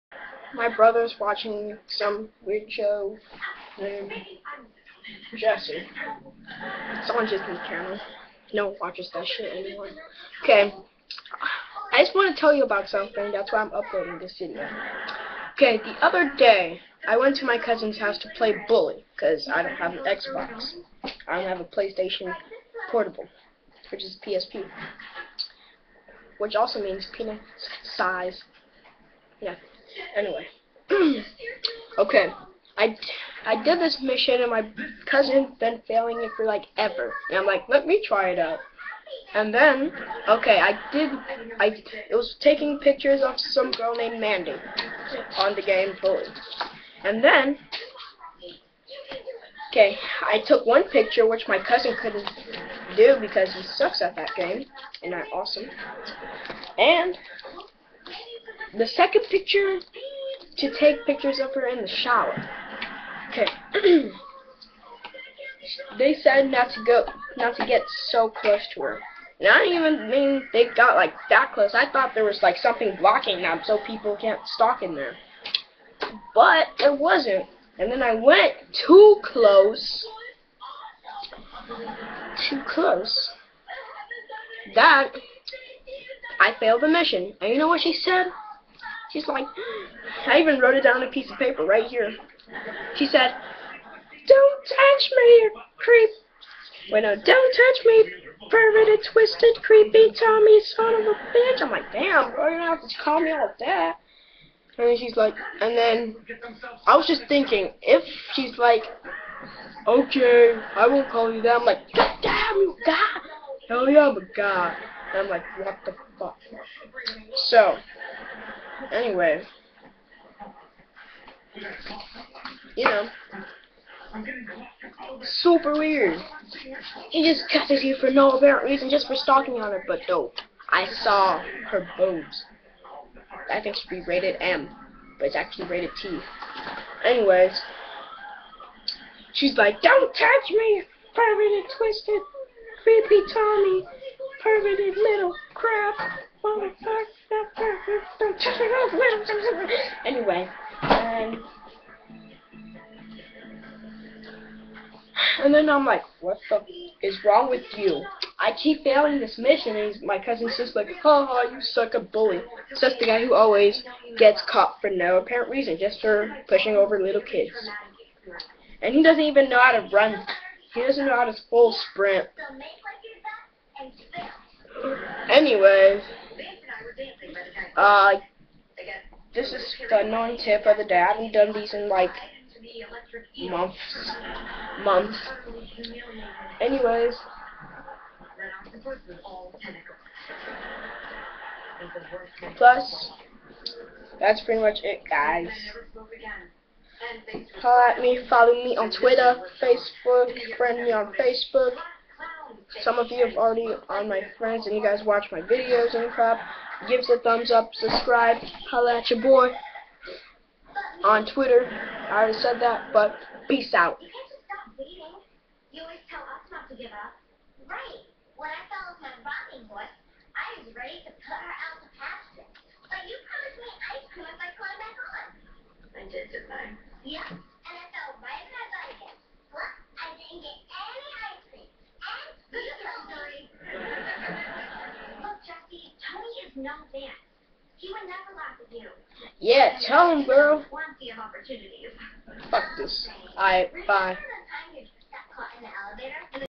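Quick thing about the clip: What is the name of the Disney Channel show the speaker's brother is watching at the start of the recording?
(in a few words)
Jessie.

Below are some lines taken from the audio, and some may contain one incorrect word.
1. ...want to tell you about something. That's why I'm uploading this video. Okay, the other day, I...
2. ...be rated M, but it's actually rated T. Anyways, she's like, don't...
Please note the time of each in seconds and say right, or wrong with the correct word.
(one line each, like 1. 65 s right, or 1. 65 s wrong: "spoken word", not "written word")
1. 12 s right
2. 133 s right.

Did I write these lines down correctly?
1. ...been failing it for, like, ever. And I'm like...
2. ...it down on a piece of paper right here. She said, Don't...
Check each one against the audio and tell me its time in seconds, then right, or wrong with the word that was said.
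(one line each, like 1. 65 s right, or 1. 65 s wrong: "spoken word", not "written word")
1. 35 s right
2. 90 s right.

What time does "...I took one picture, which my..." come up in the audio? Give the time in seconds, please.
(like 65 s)
50 s.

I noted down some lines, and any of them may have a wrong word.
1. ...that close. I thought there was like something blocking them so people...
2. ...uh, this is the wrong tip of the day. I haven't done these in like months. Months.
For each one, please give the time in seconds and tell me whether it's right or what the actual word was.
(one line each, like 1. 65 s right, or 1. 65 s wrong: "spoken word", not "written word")
1. 71 s right
2. 177 s wrong: "annoying", not "wrong".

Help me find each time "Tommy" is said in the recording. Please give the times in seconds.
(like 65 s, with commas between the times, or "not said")
100 s, 143 s.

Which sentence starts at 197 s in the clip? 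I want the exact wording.
Follow me, follow me on Twitter, Facebook, friend me on Facebook.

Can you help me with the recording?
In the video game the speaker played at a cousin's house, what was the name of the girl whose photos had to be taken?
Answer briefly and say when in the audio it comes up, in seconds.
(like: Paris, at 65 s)
Mandy, at 44 s.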